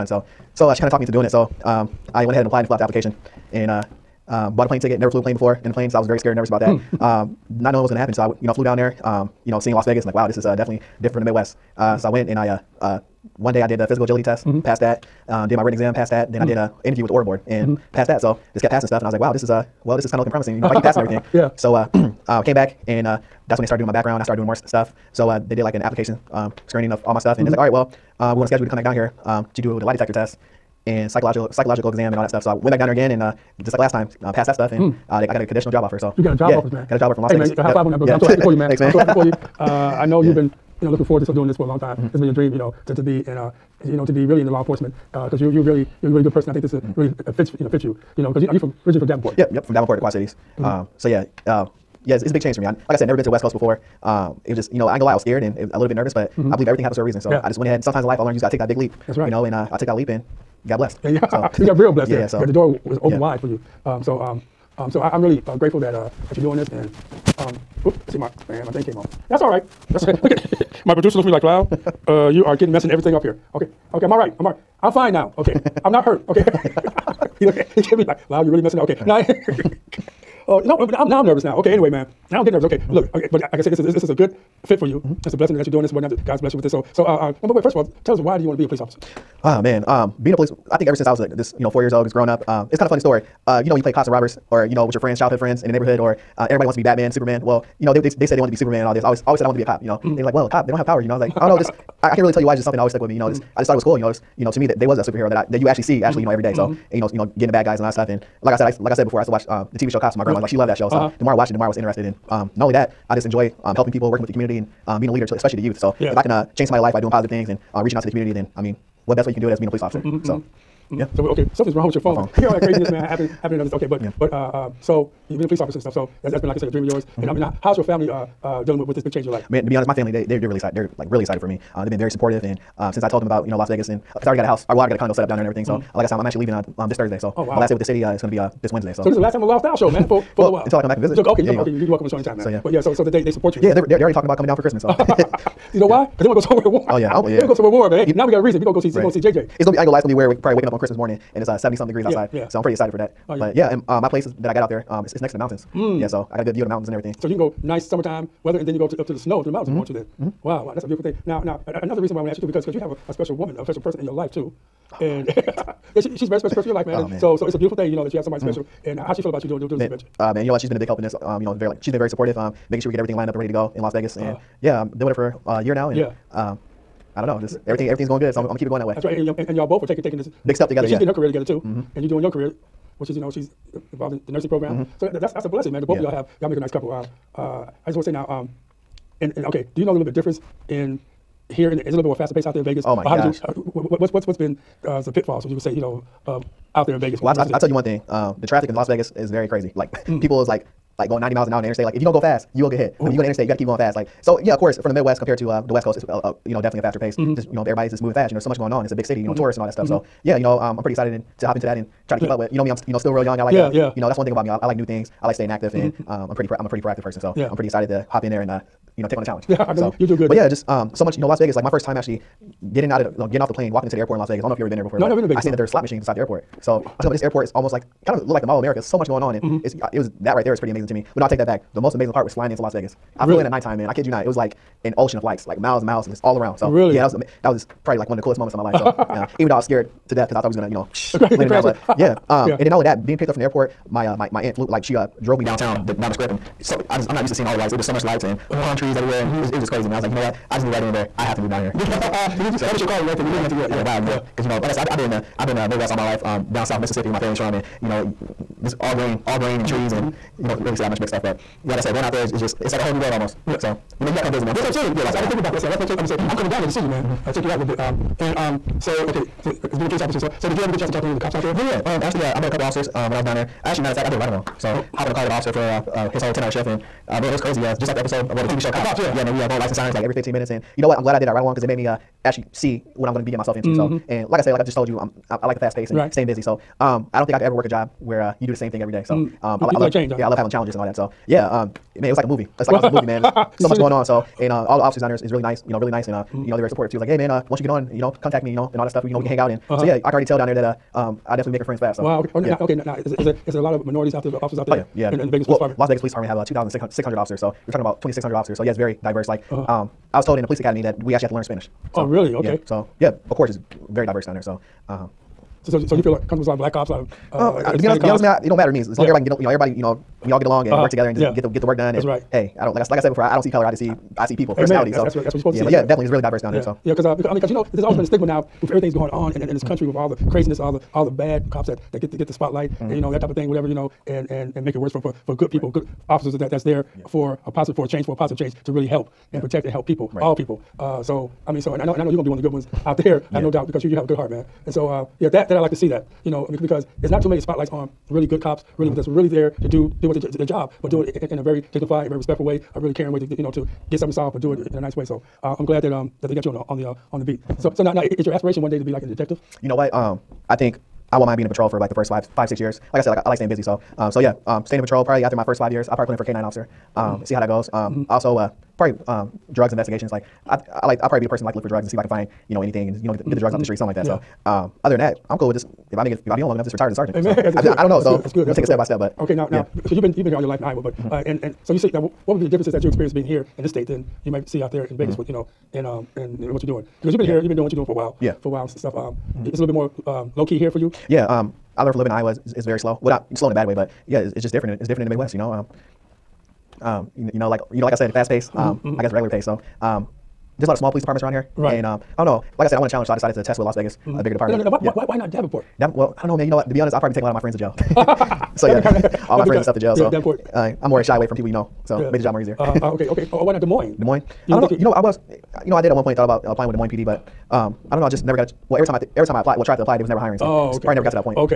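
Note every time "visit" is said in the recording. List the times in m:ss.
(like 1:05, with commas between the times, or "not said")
2:21, 4:24.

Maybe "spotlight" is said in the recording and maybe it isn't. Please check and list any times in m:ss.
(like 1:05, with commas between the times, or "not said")
5:32, 5:47.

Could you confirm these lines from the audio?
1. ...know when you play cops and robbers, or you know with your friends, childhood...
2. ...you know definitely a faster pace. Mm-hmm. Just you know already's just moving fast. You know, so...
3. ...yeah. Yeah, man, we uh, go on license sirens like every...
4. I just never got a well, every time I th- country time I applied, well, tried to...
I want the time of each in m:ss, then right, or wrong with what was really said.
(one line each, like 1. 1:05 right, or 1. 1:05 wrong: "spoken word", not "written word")
1. 1:33 right
2. 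3:26 wrong: "everybody", not "already"
3. 4:38 right
4. 6:58 wrong: "every", not "country".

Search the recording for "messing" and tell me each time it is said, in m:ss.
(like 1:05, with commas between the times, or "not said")
1:12, 1:18.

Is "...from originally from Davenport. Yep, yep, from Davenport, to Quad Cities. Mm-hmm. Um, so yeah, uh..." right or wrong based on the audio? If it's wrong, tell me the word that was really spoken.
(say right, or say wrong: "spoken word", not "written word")
right.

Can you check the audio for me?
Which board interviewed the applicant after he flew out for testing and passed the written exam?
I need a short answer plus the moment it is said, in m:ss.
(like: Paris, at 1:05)
Aura Board, at 0:17.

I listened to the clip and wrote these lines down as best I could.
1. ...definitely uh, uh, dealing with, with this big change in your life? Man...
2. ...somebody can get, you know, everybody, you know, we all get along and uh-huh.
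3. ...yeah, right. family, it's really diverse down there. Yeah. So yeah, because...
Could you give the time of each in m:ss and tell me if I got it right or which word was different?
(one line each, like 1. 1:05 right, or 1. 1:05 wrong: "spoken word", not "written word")
1. 2:07 wrong: "family", not "definitely"
2. 5:19 wrong: "everybody", not "somebody"
3. 5:25 wrong: "definitely", not "family".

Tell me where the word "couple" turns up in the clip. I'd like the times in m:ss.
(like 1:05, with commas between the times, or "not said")
3:06, 4:32.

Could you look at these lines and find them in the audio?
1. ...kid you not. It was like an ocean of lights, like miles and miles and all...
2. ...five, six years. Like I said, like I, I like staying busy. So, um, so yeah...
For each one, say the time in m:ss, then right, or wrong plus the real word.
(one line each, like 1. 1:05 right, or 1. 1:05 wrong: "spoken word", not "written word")
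1. 3:53 right
2. 6:02 right.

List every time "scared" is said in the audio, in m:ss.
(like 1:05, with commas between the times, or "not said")
0:06, 0:55, 3:59.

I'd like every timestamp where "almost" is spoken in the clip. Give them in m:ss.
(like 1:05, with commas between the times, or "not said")
3:47, 4:23.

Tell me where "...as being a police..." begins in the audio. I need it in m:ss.
1:59.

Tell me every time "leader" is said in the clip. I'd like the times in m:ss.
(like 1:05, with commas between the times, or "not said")
1:55.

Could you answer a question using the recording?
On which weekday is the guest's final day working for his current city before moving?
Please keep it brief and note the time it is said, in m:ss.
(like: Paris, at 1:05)
Wednesday, at 2:18.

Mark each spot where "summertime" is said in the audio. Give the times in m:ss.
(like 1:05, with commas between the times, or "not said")
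2:37.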